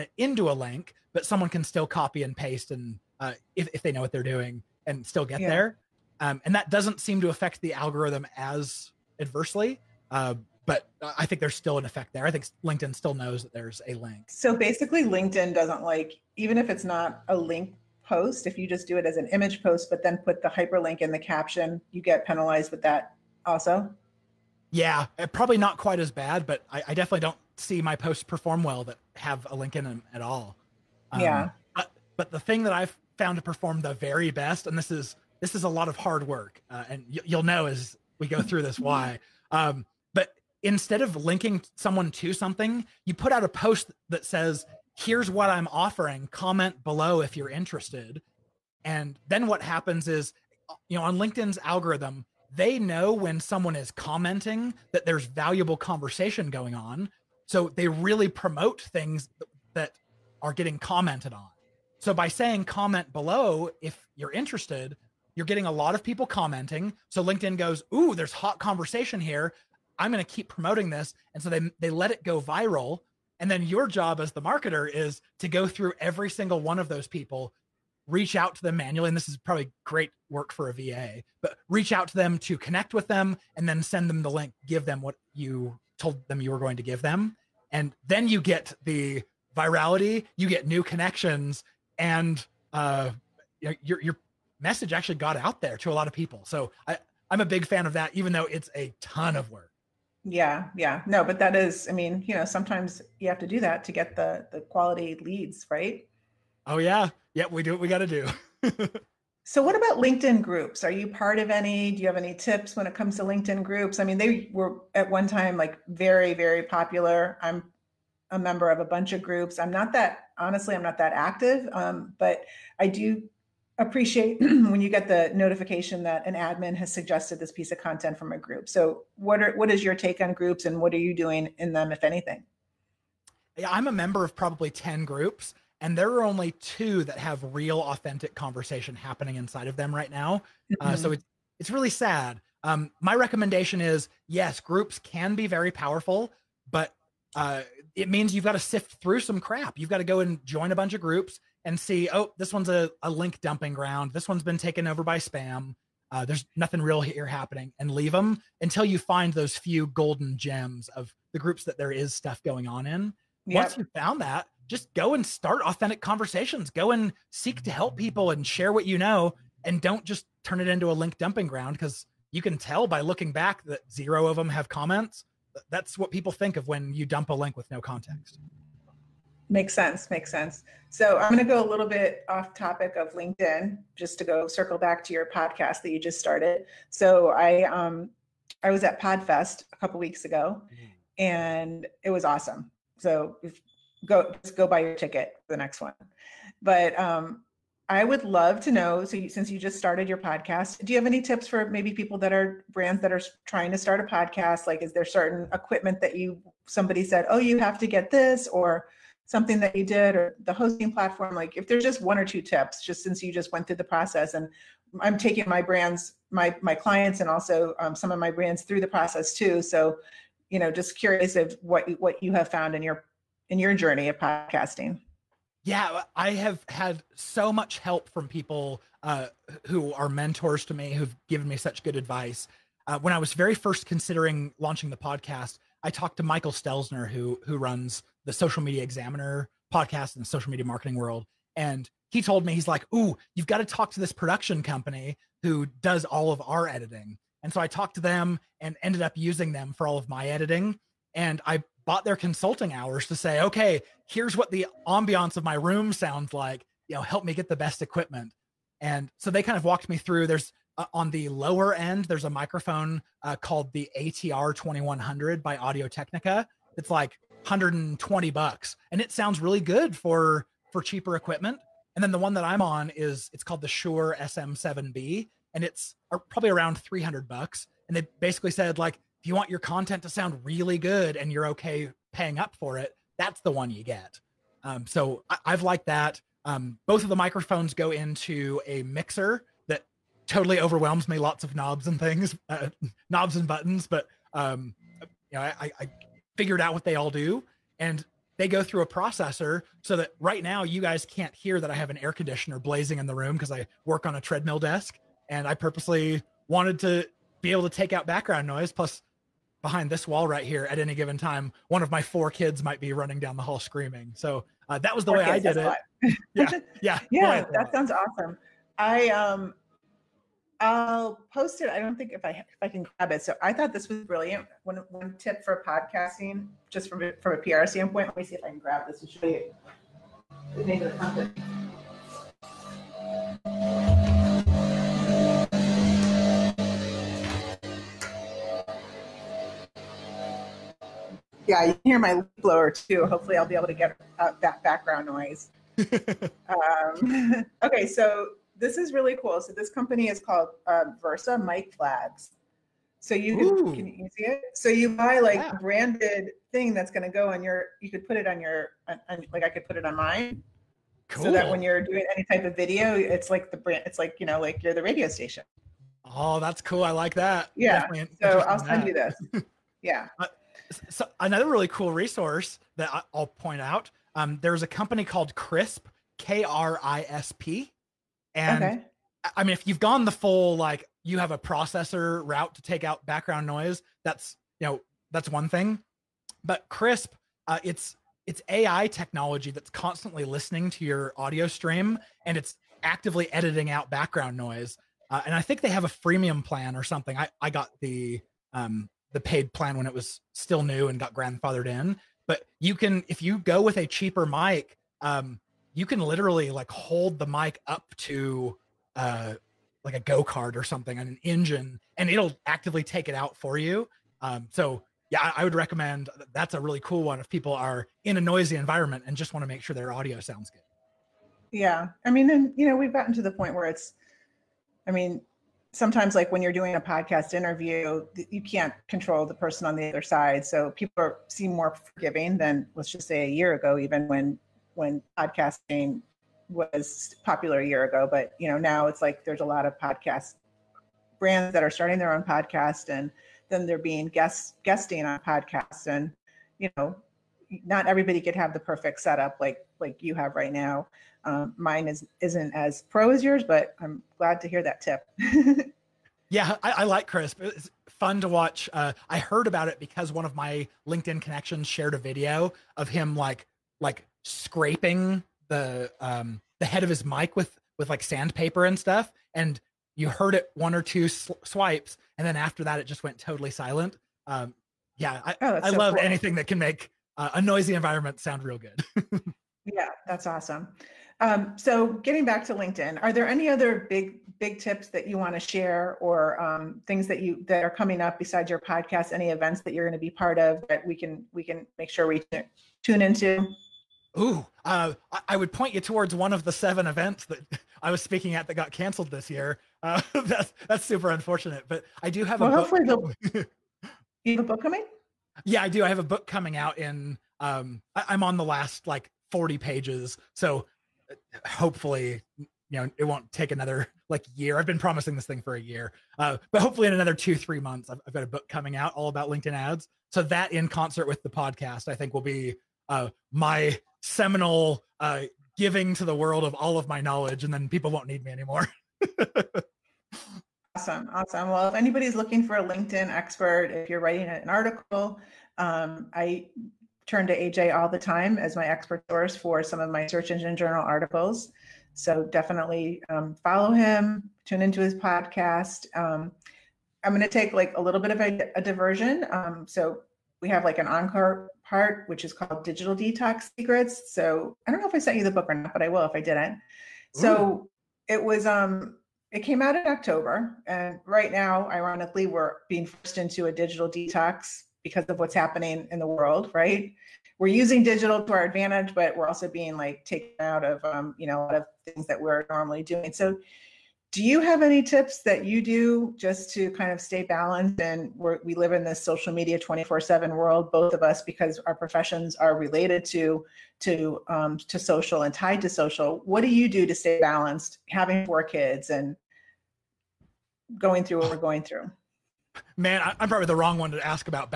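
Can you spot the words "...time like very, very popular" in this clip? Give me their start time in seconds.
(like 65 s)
115 s.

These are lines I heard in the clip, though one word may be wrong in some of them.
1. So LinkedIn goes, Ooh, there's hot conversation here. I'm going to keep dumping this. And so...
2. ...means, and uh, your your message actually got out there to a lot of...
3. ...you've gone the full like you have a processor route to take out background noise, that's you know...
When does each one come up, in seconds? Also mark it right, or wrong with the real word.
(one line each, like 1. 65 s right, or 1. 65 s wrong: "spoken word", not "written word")
1. 67 s wrong: "promoting", not "dumping"
2. 90 s wrong: "connections", not "means"
3. 379 s right.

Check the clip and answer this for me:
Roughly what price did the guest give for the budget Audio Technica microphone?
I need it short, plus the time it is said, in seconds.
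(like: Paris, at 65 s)
$120, at 267 s.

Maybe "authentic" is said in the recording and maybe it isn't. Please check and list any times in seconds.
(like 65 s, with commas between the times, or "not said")
137 s, 165 s.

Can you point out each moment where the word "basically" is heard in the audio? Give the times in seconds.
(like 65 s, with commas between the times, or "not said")
14 s, 278 s.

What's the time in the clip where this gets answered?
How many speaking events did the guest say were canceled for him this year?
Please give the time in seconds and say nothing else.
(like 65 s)
496 s.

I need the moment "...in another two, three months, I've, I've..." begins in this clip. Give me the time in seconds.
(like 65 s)
516 s.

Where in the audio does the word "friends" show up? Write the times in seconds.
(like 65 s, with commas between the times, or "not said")
not said.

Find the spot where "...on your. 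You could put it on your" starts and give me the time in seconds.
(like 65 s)
357 s.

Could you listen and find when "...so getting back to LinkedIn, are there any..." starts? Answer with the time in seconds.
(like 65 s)
481 s.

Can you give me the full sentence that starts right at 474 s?
Um, yeah, I, oh, I so love cool.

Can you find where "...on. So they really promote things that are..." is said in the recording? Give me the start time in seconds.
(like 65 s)
56 s.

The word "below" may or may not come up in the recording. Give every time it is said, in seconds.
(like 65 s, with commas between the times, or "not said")
46 s, 63 s.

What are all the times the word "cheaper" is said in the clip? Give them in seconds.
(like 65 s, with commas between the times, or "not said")
270 s, 403 s.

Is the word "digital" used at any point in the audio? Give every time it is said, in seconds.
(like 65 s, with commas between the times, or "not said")
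552 s, 563 s, 567 s.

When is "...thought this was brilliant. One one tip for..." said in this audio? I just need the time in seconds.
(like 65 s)
323 s.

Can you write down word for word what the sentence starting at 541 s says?
So definitely um, follow him, tune into his podcast.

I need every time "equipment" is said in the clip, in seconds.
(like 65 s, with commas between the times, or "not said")
205 s, 257 s, 271 s.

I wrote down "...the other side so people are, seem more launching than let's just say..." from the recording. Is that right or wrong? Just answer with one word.
wrong.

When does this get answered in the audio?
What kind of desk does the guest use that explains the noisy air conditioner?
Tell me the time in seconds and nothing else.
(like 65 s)
304 s.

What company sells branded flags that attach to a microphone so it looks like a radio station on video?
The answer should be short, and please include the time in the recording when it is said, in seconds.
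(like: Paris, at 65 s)
Versa Mic Flags, at 351 s.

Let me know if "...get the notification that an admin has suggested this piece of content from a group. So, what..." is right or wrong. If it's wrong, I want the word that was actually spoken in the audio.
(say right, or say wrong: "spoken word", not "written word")
right.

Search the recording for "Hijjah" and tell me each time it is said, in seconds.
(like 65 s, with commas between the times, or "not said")
not said.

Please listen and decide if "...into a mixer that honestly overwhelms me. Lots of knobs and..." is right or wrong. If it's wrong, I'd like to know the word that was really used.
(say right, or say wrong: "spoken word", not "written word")
wrong: "totally", not "honestly".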